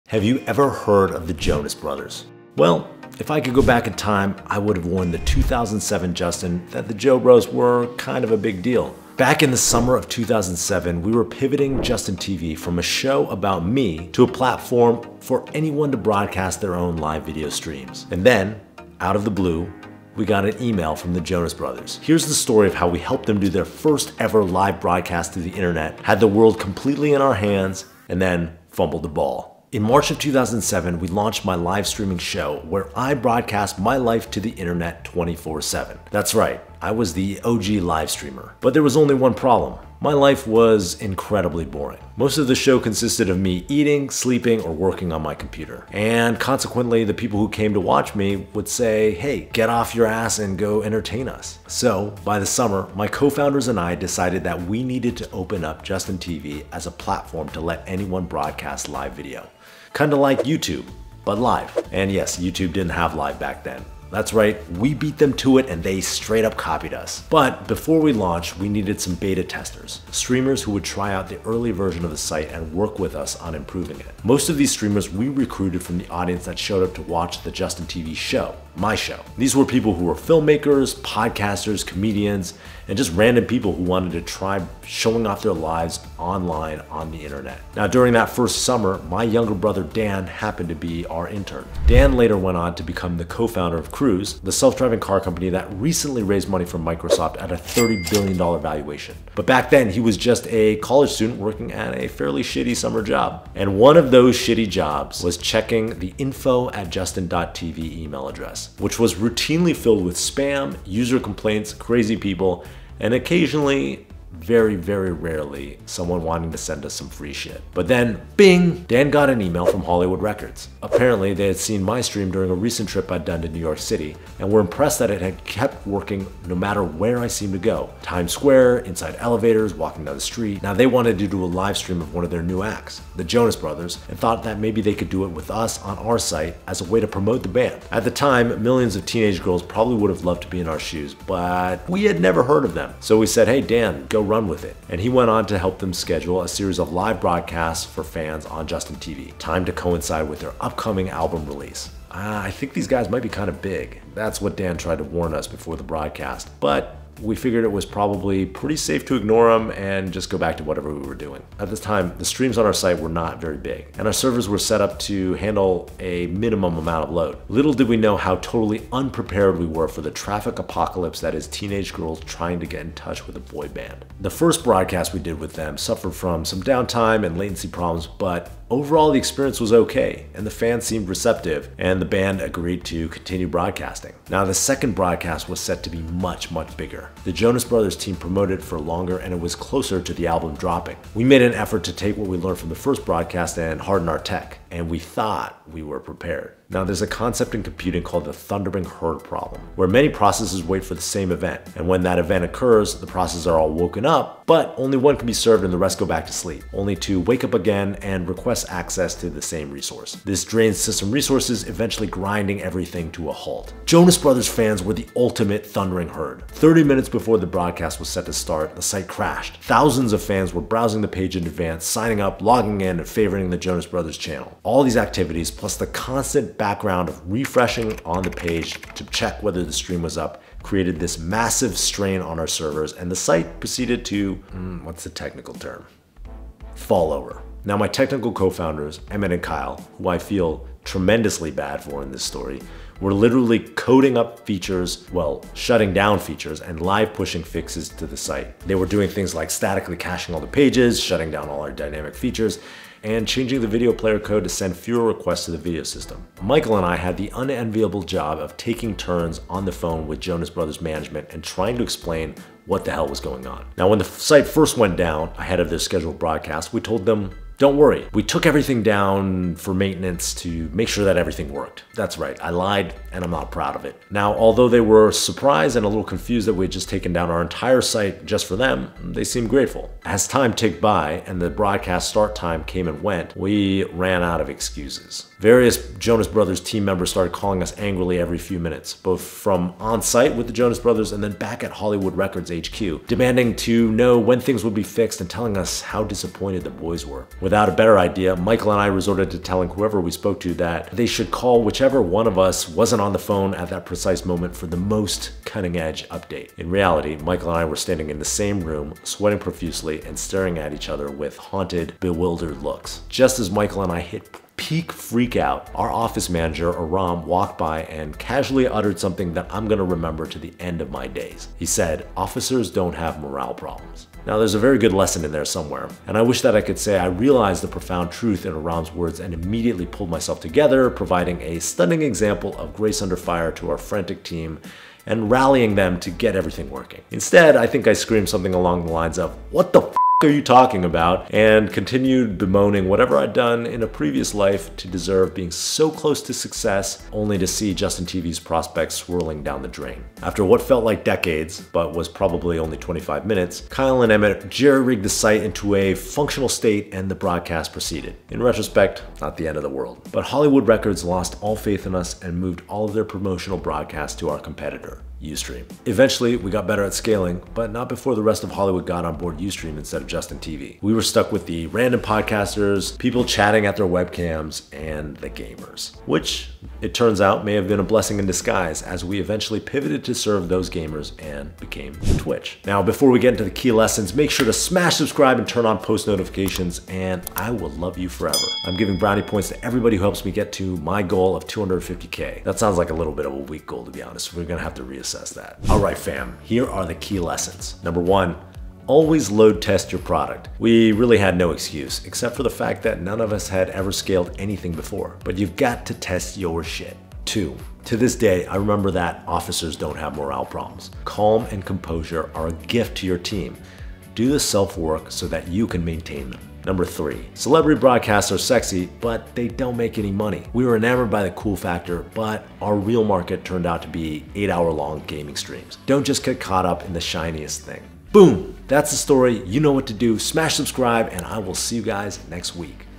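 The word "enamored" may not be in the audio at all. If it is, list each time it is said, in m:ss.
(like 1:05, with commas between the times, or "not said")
7:00.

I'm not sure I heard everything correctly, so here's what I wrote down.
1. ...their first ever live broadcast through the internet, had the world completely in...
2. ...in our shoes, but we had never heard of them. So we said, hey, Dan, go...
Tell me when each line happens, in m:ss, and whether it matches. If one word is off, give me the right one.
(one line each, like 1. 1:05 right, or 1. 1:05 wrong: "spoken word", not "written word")
1. 0:23 right
2. 2:20 right.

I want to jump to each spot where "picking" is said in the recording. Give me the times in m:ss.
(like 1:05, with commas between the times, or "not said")
not said.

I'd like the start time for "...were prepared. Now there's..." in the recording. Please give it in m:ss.
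3:15.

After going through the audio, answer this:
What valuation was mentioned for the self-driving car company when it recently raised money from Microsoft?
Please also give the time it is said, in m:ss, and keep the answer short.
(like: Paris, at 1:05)
$30 billion, at 1:37.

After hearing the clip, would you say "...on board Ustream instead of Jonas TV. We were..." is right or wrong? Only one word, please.
wrong.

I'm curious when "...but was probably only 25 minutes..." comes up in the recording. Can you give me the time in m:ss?
5:51.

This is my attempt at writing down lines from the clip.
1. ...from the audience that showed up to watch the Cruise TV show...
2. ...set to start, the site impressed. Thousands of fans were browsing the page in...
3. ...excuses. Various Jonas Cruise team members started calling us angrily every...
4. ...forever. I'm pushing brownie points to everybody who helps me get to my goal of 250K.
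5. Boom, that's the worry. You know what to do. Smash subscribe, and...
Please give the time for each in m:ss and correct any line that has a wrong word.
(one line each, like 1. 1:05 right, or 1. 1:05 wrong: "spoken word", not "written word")
1. 1:15 wrong: "Justin", not "Cruise"
2. 3:38 wrong: "crashed", not "impressed"
3. 4:44 wrong: "Brothers", not "Cruise"
4. 6:28 wrong: "giving", not "pushing"
5. 7:08 wrong: "story", not "worry".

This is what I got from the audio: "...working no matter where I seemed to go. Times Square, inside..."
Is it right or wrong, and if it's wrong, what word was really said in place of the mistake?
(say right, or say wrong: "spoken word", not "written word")
right.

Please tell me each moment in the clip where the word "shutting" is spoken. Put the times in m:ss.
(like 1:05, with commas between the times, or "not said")
4:05, 4:10.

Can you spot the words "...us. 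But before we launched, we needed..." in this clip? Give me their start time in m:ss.
1:06.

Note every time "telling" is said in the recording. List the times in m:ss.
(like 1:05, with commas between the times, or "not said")
4:55, 4:59.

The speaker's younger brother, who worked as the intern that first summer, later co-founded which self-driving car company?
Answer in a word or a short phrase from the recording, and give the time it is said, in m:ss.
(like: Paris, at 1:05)
Cruise, at 1:34.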